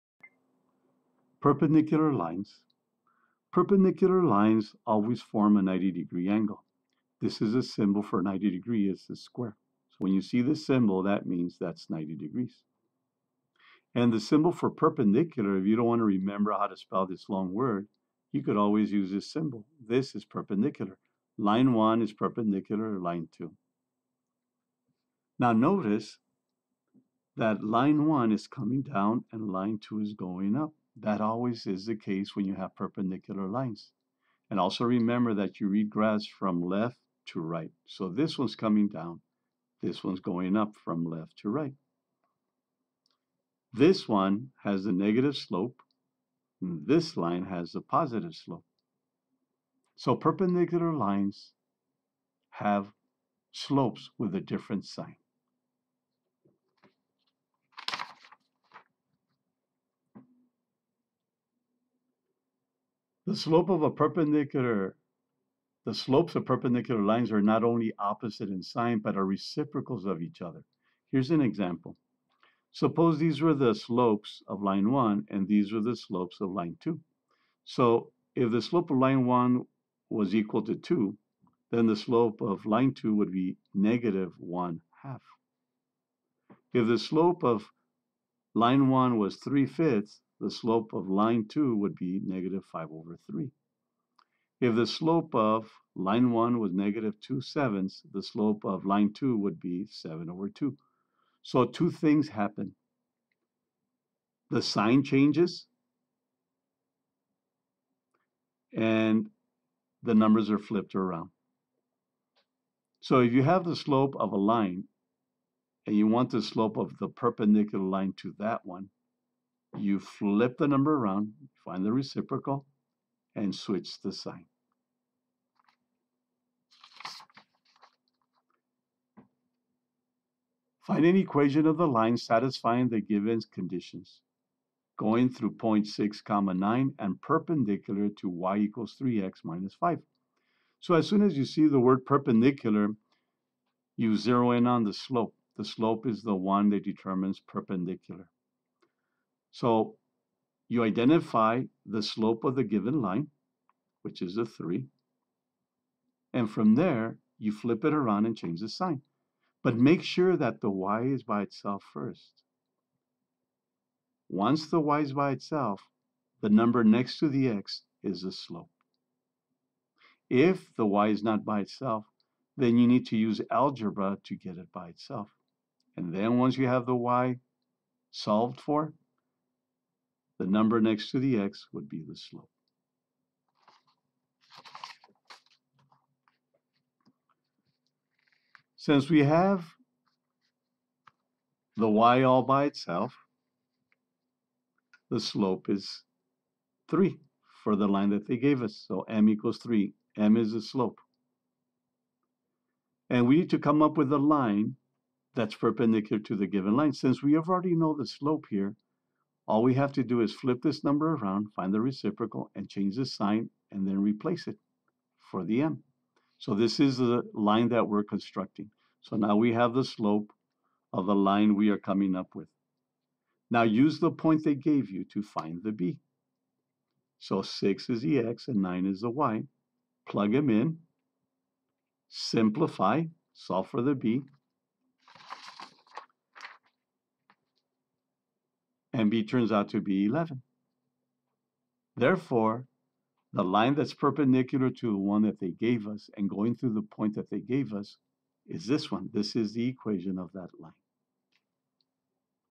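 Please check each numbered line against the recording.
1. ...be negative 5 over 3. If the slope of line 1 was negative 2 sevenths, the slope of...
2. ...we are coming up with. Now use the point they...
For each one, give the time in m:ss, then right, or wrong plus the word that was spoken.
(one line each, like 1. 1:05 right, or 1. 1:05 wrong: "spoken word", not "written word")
1. 1:31 right
2. 3:41 right.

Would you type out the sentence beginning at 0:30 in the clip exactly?
That always is the case when you have perpendicular lines.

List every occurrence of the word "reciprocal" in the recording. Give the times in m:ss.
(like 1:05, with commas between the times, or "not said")
1:09, 2:01, 3:31.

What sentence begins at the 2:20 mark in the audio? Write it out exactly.
So as soon as you see the word perpendicular, you zero in on the slope.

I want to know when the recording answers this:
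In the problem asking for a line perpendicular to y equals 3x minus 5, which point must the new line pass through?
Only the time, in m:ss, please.
2:15.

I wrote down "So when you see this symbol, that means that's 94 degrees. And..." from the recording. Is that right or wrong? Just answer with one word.
wrong.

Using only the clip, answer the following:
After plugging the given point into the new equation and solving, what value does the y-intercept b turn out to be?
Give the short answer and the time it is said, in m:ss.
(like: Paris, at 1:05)
11, at 4:00.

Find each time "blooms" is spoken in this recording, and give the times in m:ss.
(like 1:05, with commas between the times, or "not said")
not said.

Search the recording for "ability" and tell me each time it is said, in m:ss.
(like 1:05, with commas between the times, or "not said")
not said.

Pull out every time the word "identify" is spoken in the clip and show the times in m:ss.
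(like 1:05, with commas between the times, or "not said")
2:30.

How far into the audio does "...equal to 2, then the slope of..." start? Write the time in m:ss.
1:20.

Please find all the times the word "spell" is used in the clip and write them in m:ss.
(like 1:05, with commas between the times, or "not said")
0:16.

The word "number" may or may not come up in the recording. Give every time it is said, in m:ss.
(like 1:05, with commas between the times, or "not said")
1:50, 2:00, 2:46, 3:00, 3:30.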